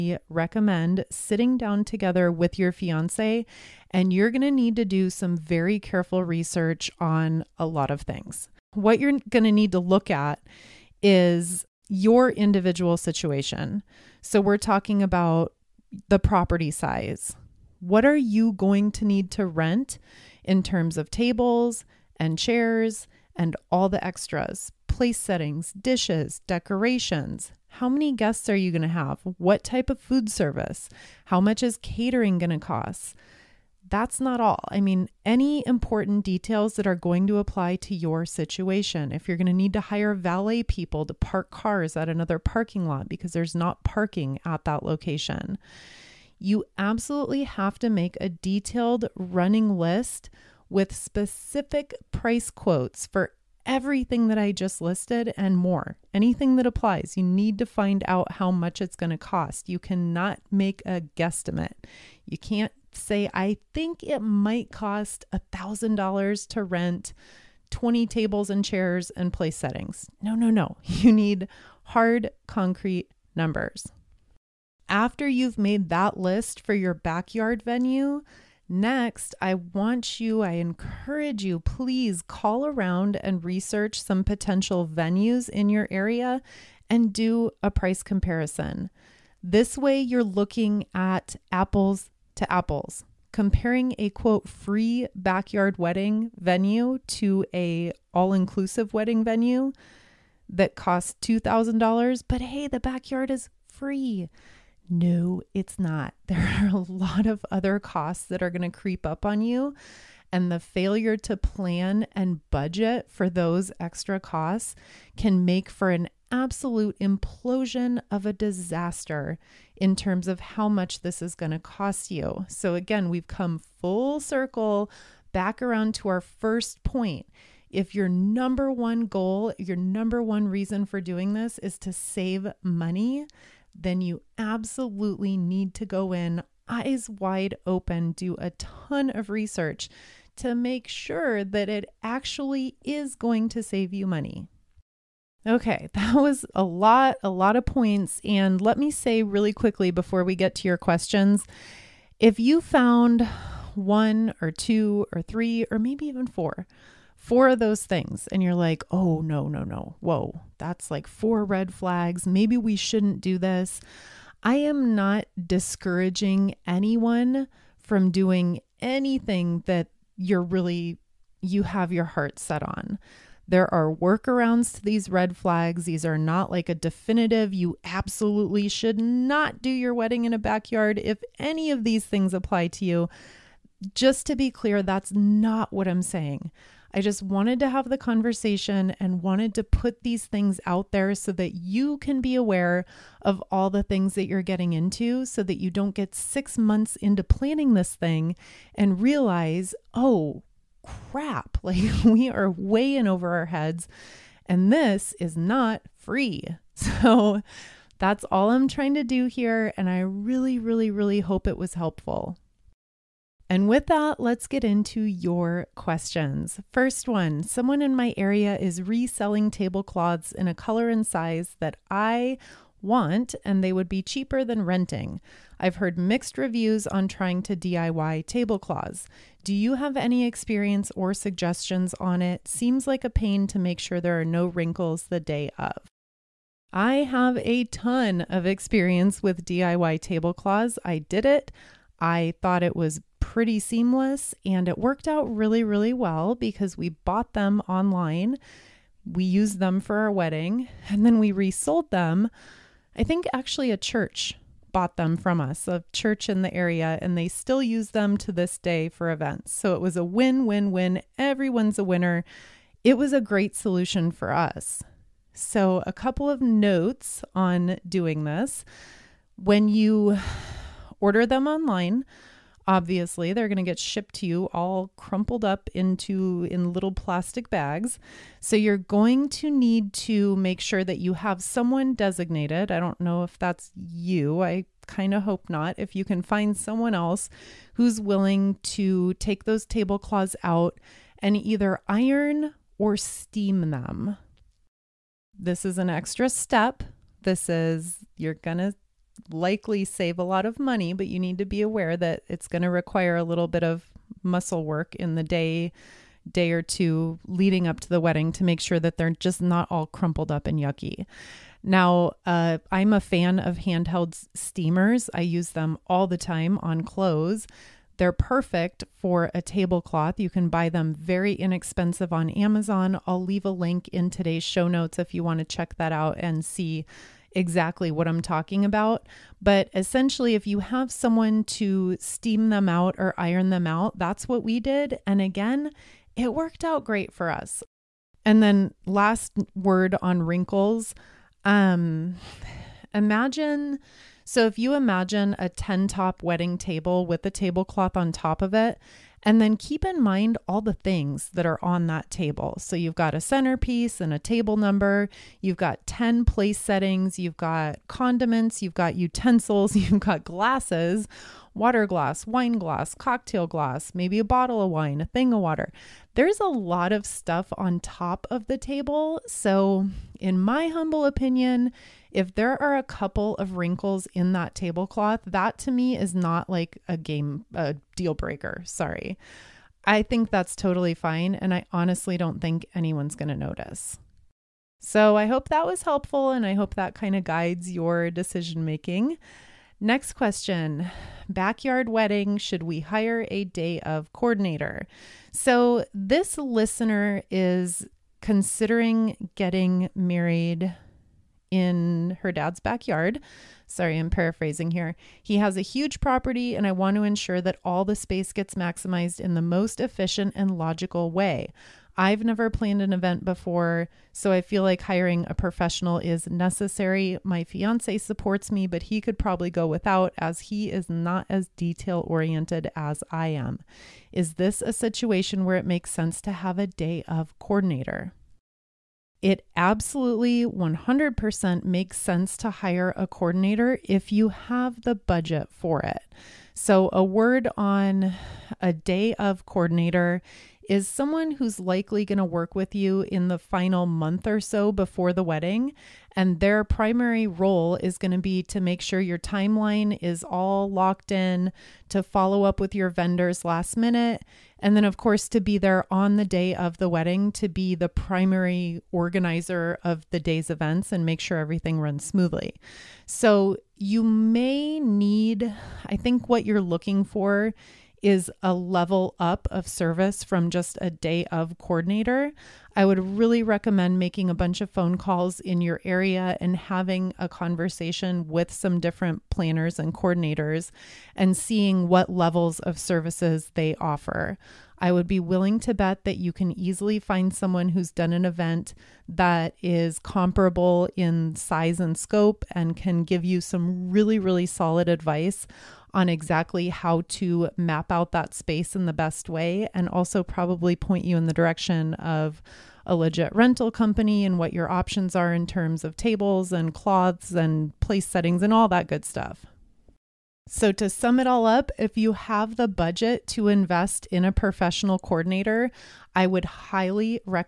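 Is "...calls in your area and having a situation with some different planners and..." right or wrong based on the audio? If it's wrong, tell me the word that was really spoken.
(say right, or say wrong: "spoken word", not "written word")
wrong: "conversation", not "situation".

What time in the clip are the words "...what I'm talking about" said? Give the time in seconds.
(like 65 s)
327 s.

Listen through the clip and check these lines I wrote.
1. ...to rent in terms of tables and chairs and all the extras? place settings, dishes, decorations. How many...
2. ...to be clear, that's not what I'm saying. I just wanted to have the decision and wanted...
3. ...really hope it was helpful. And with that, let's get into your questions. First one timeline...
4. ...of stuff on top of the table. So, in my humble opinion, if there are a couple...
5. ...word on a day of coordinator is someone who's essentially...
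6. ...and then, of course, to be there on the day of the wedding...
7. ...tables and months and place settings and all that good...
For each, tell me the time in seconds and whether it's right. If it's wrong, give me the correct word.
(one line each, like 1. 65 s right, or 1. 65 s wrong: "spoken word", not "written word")
1. 19 s right
2. 184 s wrong: "conversation", not "decision"
3. 210 s wrong: "someone", not "timeline"
4. 366 s right
5. 437 s wrong: "likely", not "essentially"
6. 454 s right
7. 505 s wrong: "cloths", not "months".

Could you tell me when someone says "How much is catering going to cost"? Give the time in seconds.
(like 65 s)
31 s.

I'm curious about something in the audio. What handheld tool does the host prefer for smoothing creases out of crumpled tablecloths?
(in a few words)
Handheld steamers.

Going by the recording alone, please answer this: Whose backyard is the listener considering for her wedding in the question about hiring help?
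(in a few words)
Her dad's.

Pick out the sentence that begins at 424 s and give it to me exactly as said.
Is this a situation where it makes sense to have a day of coordinator?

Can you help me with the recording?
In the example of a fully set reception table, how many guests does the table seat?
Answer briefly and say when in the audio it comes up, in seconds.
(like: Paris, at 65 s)
10, at 345 s.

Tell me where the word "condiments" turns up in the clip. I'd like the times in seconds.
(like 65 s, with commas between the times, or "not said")
357 s.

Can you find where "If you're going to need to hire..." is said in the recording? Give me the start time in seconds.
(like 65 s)
39 s.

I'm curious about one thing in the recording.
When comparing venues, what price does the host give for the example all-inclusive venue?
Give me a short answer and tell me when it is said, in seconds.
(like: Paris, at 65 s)
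$2,000, at 101 s.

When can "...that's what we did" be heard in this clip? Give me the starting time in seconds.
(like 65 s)
333 s.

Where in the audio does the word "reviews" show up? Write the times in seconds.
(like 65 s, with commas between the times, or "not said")
226 s.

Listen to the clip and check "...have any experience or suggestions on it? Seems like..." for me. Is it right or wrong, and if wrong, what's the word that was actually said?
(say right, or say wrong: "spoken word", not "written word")
right.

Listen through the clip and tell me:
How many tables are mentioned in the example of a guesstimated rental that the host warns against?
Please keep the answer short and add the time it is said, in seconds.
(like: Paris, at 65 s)
20, at 67 s.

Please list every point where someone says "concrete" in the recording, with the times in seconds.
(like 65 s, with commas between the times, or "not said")
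72 s.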